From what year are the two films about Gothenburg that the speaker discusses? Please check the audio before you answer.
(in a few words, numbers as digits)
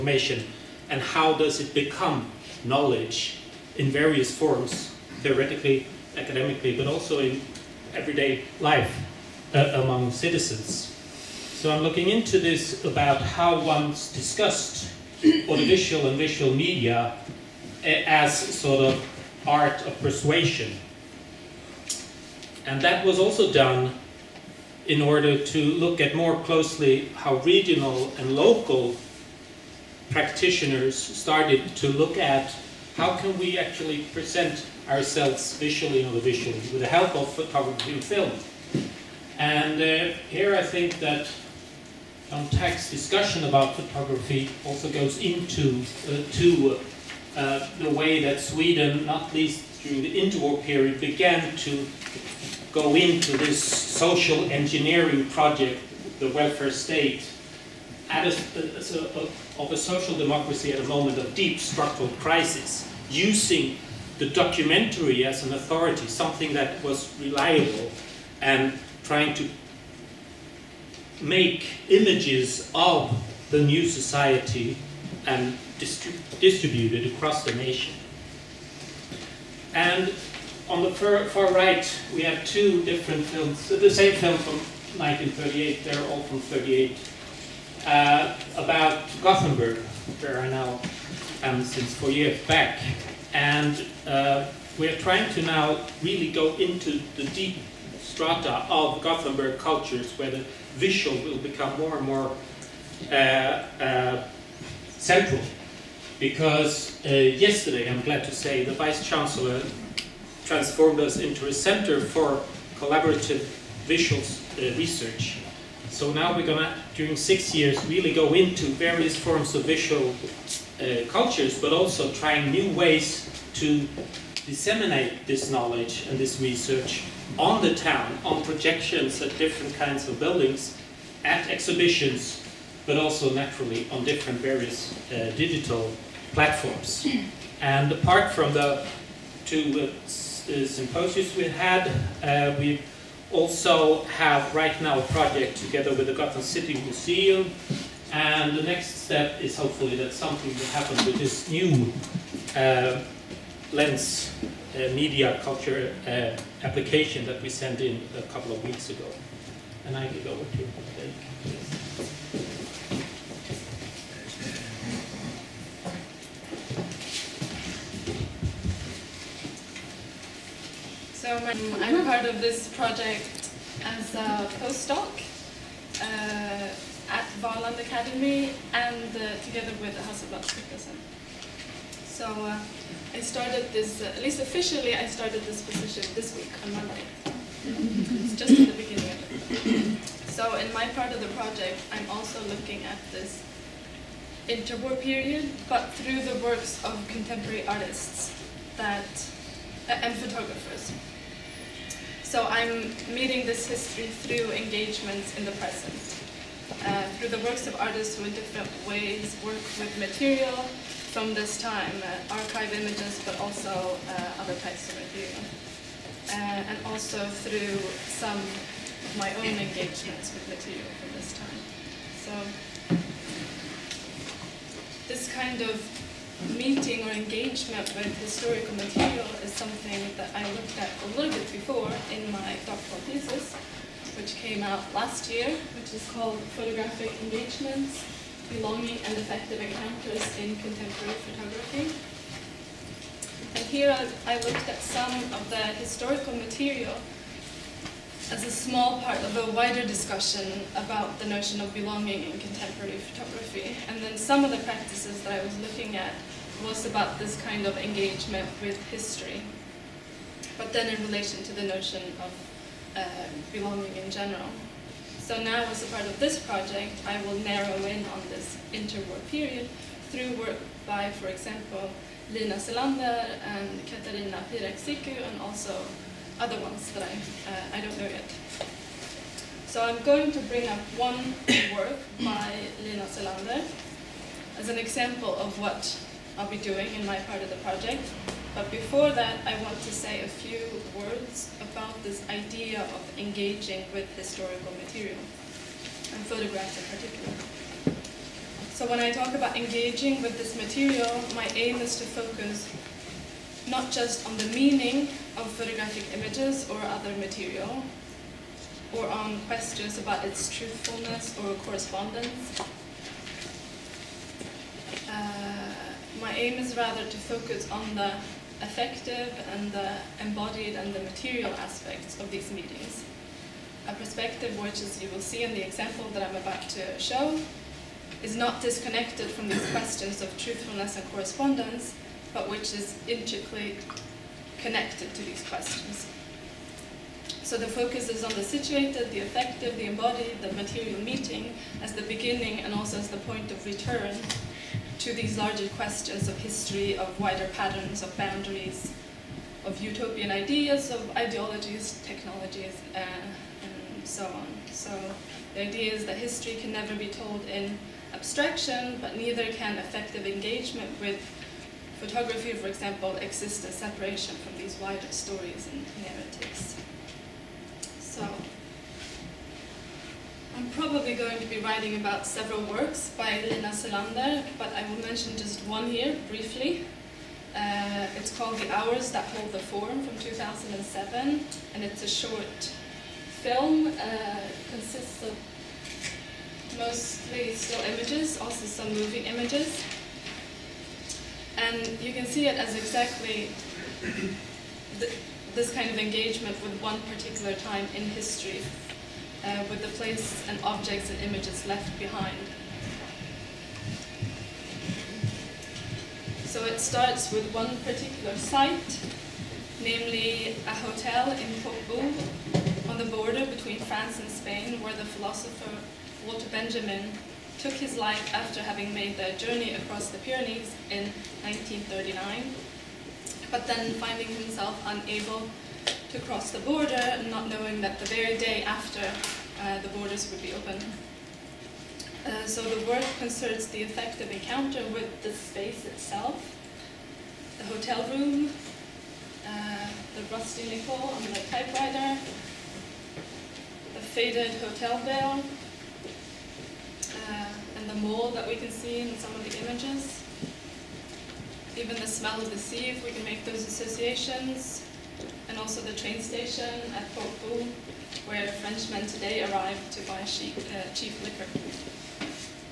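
1938.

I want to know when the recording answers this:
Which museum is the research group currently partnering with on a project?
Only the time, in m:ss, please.
2:26.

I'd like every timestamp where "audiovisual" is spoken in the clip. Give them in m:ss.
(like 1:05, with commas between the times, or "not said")
0:15.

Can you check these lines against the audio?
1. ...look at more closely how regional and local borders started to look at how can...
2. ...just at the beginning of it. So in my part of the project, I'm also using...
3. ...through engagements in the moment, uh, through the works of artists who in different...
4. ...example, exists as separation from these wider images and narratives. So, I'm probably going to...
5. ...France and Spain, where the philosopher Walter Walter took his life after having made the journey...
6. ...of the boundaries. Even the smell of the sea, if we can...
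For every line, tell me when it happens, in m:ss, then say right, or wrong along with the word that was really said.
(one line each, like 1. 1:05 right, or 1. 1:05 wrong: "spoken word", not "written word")
1. 0:25 wrong: "practitioners", not "borders"
2. 3:08 wrong: "looking", not "using"
3. 3:24 wrong: "present", not "moment"
4. 6:02 wrong: "stories", not "images"
5. 6:53 wrong: "Benjamin", not "Walter"
6. 7:29 wrong: "images", not "boundaries".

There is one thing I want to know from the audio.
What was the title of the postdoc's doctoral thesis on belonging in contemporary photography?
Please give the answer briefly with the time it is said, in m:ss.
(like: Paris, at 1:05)
Photographic Engagements, at 3:56.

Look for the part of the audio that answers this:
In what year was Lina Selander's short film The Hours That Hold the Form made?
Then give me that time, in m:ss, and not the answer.
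6:20.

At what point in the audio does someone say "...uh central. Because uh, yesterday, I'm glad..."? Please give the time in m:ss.
1:43.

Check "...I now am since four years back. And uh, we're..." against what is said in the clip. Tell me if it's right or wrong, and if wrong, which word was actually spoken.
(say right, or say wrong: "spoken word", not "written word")
right.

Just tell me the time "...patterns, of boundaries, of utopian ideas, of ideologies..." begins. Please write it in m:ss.
5:47.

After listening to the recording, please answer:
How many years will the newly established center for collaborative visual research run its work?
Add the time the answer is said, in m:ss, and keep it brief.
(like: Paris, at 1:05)
6 years, at 1:57.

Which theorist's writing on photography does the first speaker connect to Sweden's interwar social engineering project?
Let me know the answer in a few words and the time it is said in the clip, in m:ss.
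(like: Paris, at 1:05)
John Tagg, at 0:42.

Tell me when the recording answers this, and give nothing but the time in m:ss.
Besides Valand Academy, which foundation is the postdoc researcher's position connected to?
3:00.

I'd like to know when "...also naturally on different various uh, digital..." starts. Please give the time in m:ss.
2:12.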